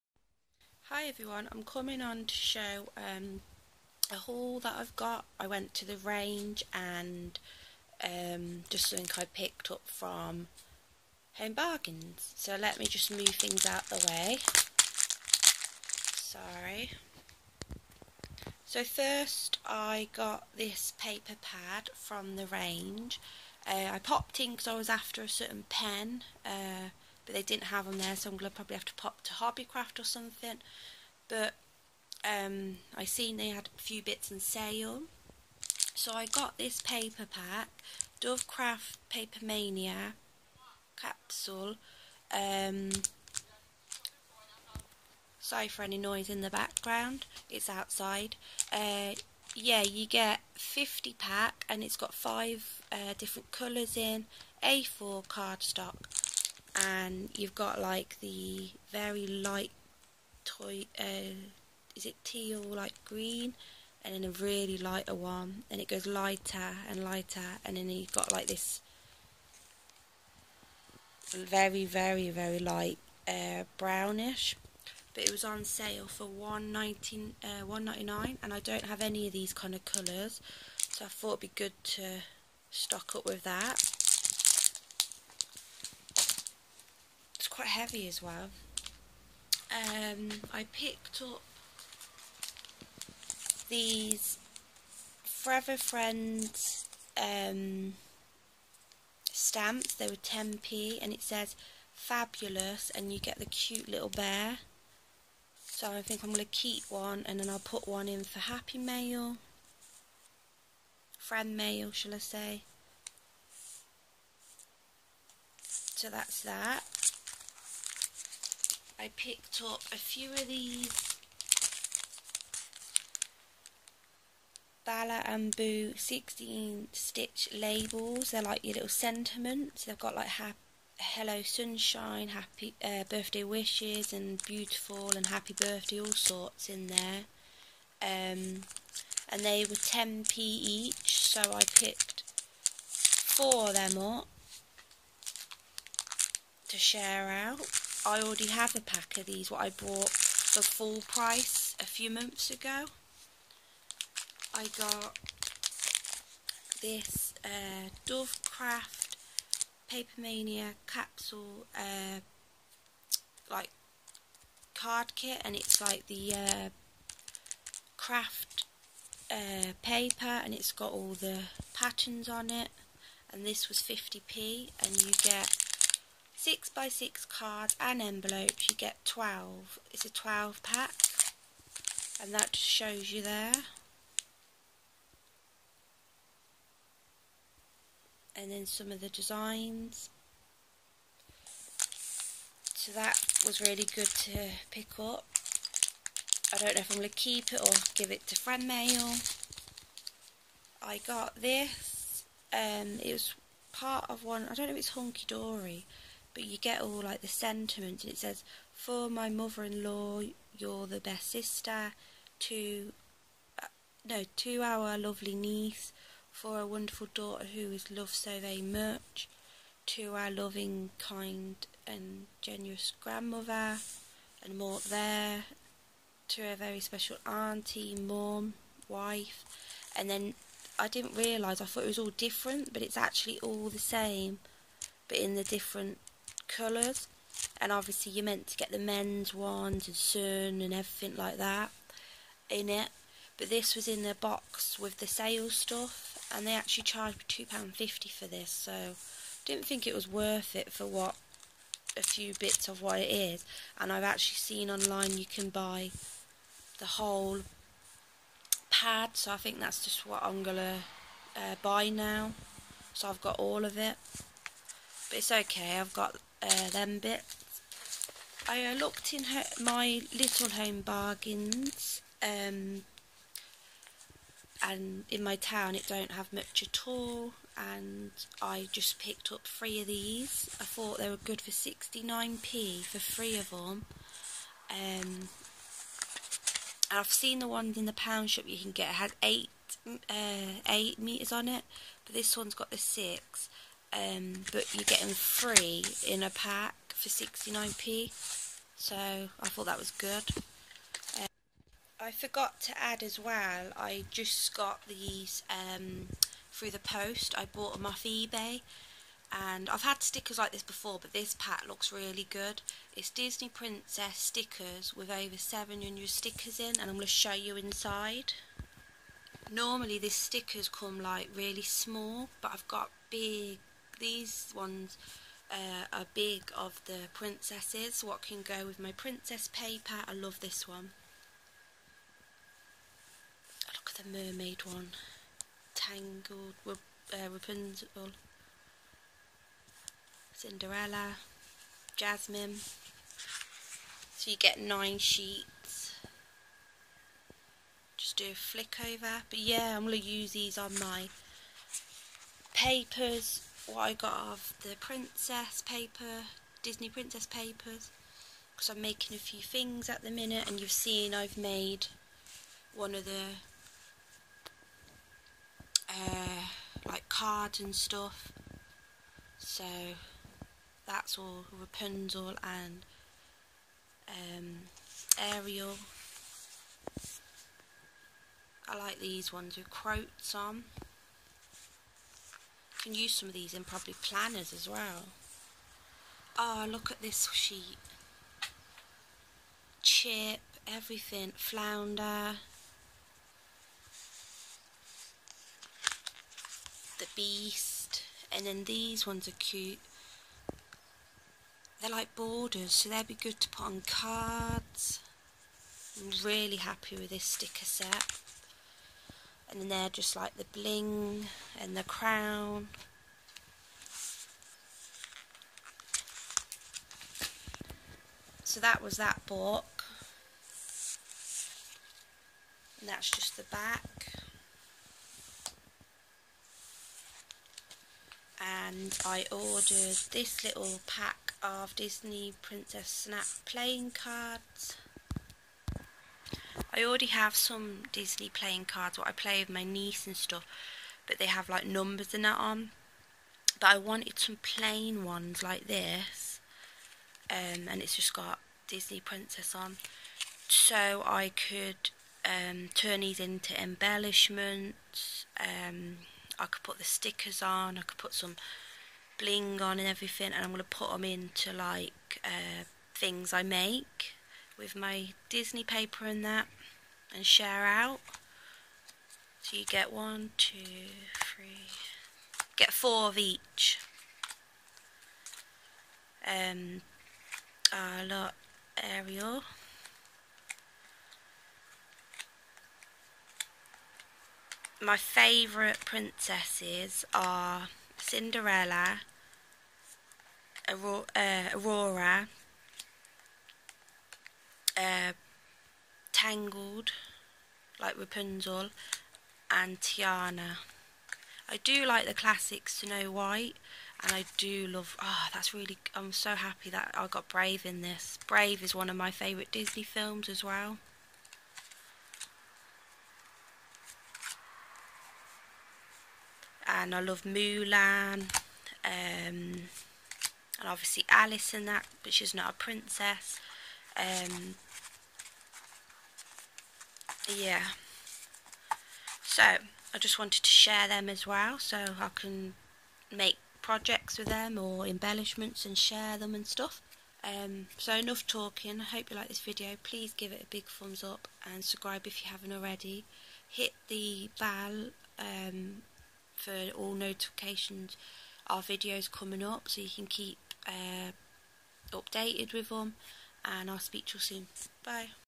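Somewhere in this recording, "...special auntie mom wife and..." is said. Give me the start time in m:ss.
3:46.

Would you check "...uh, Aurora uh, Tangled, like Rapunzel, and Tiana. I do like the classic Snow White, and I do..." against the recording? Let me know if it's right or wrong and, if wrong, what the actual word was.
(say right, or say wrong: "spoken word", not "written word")
right.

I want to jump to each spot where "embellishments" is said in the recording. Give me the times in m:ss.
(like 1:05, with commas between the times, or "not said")
7:33, 8:54.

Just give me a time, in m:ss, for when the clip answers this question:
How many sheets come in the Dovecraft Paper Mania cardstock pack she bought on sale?
0:50.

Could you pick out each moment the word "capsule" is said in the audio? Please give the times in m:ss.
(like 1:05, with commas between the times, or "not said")
0:40, 2:40.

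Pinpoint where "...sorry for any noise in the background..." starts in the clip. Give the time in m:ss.
0:45.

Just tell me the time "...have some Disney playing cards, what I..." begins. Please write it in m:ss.
7:17.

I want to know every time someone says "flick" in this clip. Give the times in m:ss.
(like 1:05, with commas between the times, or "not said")
5:48.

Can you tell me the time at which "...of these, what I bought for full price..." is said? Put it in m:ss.
2:29.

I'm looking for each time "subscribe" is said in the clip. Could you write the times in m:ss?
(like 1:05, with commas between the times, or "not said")
9:01.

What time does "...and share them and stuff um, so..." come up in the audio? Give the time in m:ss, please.
8:55.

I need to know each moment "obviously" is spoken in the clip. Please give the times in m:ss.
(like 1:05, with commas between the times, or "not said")
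3:57, 8:40.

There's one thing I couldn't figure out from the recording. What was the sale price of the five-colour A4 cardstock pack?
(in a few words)
£1.19.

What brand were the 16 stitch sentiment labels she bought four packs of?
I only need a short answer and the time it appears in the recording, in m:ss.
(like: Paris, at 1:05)
Bala and Boo, at 2:04.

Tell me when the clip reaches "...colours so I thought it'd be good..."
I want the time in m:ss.
1:19.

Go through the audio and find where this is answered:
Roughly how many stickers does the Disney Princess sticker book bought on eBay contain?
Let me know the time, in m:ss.
5:15.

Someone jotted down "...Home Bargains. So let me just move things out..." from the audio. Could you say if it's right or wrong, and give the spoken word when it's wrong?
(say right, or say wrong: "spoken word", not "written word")
right.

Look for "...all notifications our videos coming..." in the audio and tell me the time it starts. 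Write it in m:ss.
9:06.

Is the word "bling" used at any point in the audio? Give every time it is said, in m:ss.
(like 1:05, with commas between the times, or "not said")
6:50, 7:39.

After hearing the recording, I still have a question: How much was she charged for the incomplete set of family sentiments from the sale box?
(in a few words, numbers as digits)
£2.50.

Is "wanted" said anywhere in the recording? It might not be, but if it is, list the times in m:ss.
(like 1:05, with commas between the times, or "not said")
7:23, 8:50.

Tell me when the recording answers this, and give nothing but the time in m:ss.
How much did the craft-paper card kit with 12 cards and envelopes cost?
2:53.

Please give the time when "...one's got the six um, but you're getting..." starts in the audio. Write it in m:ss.
4:52.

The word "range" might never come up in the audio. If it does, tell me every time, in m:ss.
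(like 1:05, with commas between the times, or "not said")
0:05, 0:22.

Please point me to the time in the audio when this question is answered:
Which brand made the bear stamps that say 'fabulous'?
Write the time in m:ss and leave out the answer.
1:35.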